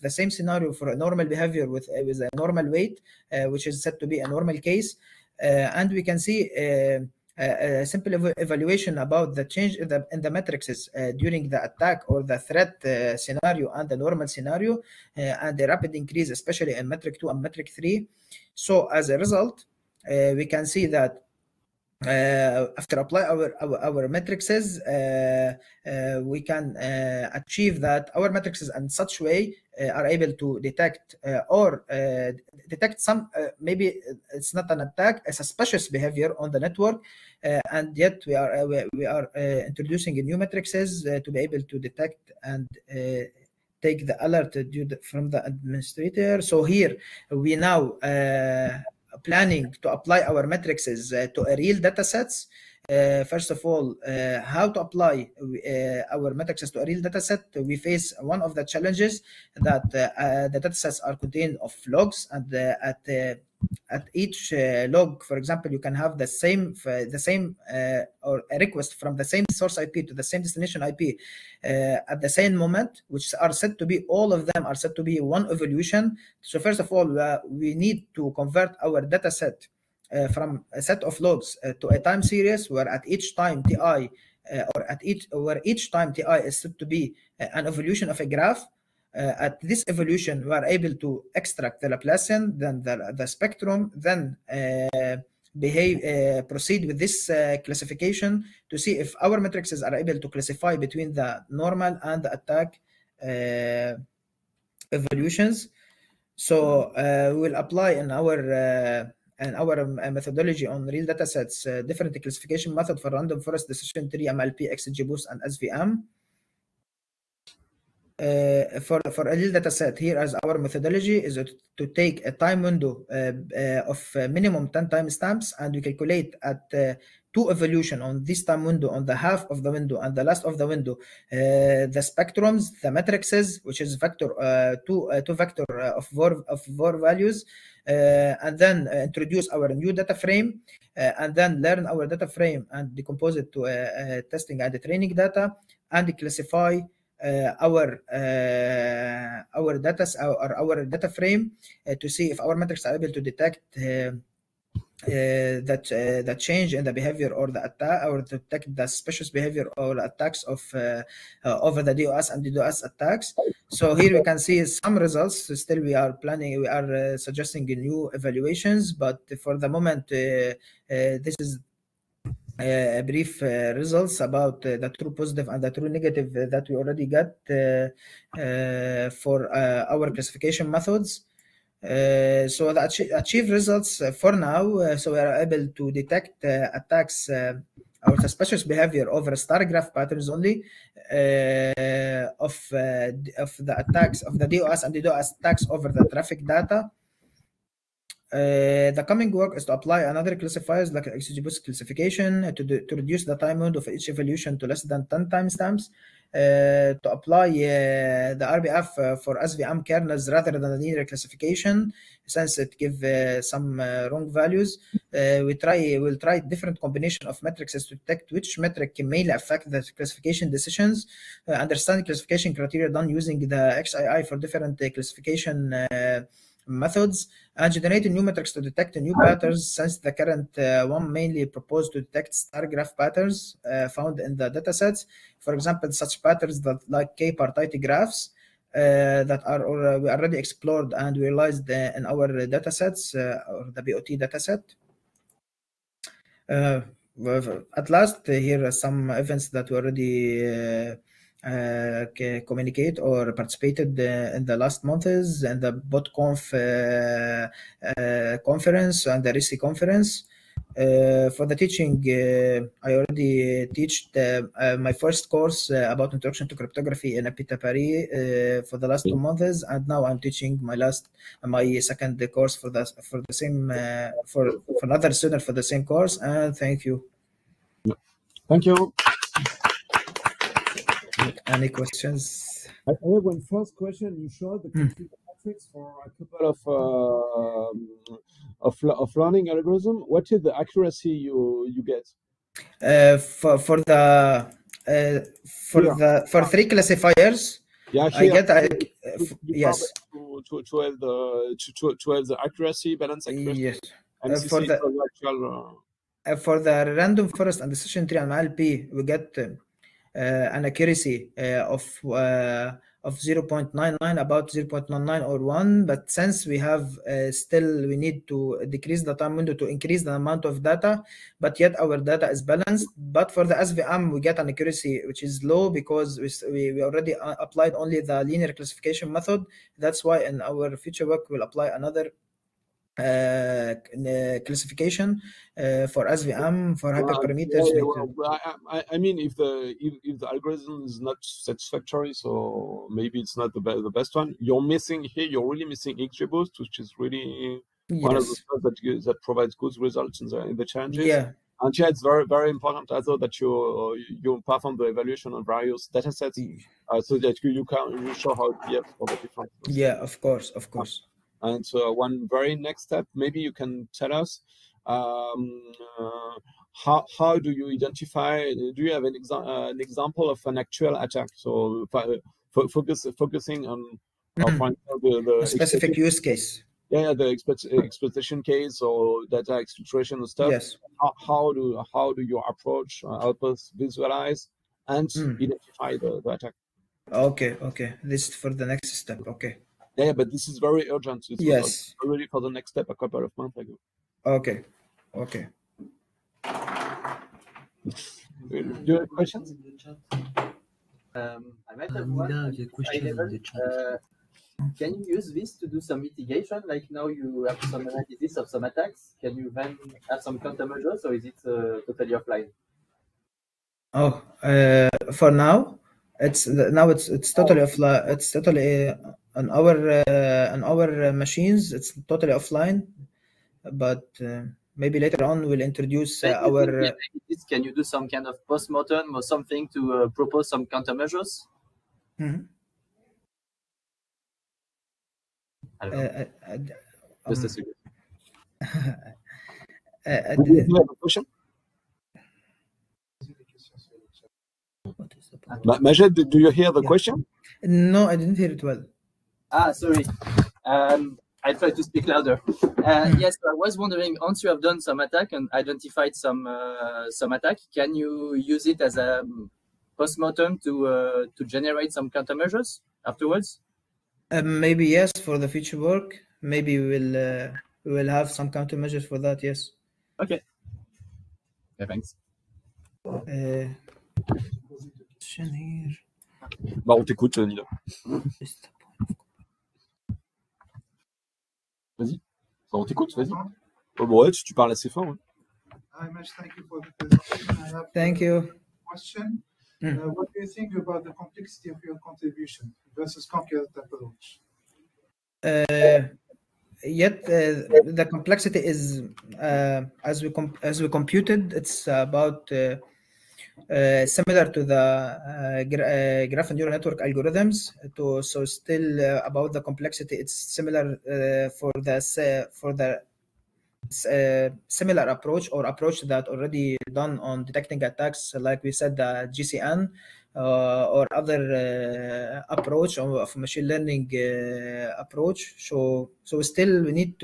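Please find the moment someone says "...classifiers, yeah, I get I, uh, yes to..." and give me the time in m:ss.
4:56.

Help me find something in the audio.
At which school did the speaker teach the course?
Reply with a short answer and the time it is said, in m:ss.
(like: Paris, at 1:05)
Epita Paris, at 4:27.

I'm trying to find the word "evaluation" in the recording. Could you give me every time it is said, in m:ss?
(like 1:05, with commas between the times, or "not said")
0:08, 2:48, 5:54.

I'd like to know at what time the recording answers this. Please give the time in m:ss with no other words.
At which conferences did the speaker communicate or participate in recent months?
4:15.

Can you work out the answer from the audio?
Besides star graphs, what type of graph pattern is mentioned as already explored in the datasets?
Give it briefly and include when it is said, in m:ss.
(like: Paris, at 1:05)
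K-partite graphs, at 3:57.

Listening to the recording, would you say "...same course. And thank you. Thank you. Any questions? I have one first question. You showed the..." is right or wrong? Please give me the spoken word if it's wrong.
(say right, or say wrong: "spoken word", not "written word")
right.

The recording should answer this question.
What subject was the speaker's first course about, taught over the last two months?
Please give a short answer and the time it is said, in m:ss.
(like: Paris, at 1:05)
Introduction to cryptography, at 4:26.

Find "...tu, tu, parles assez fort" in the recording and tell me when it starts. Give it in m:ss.
8:04.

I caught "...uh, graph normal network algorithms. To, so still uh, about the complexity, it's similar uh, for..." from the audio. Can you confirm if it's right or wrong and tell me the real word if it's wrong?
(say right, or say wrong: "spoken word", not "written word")
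wrong: "neural", not "normal".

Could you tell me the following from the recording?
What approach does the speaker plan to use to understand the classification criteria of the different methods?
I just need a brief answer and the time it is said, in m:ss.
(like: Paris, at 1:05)
XAI, at 3:43.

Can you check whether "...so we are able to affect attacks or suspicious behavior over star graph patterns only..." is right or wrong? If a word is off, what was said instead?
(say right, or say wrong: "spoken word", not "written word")
wrong: "detect", not "affect".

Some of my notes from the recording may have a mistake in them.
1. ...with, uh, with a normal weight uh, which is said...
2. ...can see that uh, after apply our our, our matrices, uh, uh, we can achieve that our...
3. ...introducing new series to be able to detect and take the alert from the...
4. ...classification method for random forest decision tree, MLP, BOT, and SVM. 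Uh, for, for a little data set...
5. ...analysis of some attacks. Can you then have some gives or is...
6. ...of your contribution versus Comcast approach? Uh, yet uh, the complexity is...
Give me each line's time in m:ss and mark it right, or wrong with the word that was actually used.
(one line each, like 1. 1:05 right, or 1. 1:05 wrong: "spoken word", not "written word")
1. 0:01 right
2. 0:20 right
3. 0:39 wrong: "matrices", not "series"
4. 1:52 wrong: "XGBoost", not "BOT"
5. 6:47 wrong: "countermeasures", not "gives"
6. 8:11 right.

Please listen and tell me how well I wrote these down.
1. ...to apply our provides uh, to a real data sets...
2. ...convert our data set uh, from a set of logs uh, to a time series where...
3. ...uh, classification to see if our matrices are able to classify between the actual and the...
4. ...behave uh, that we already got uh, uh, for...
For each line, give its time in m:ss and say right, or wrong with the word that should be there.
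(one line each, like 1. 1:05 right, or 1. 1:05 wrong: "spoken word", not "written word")
1. 0:49 wrong: "matrices", not "provides"
2. 1:18 right
3. 1:37 wrong: "normal", not "actual"
4. 2:55 wrong: "negative", not "behave".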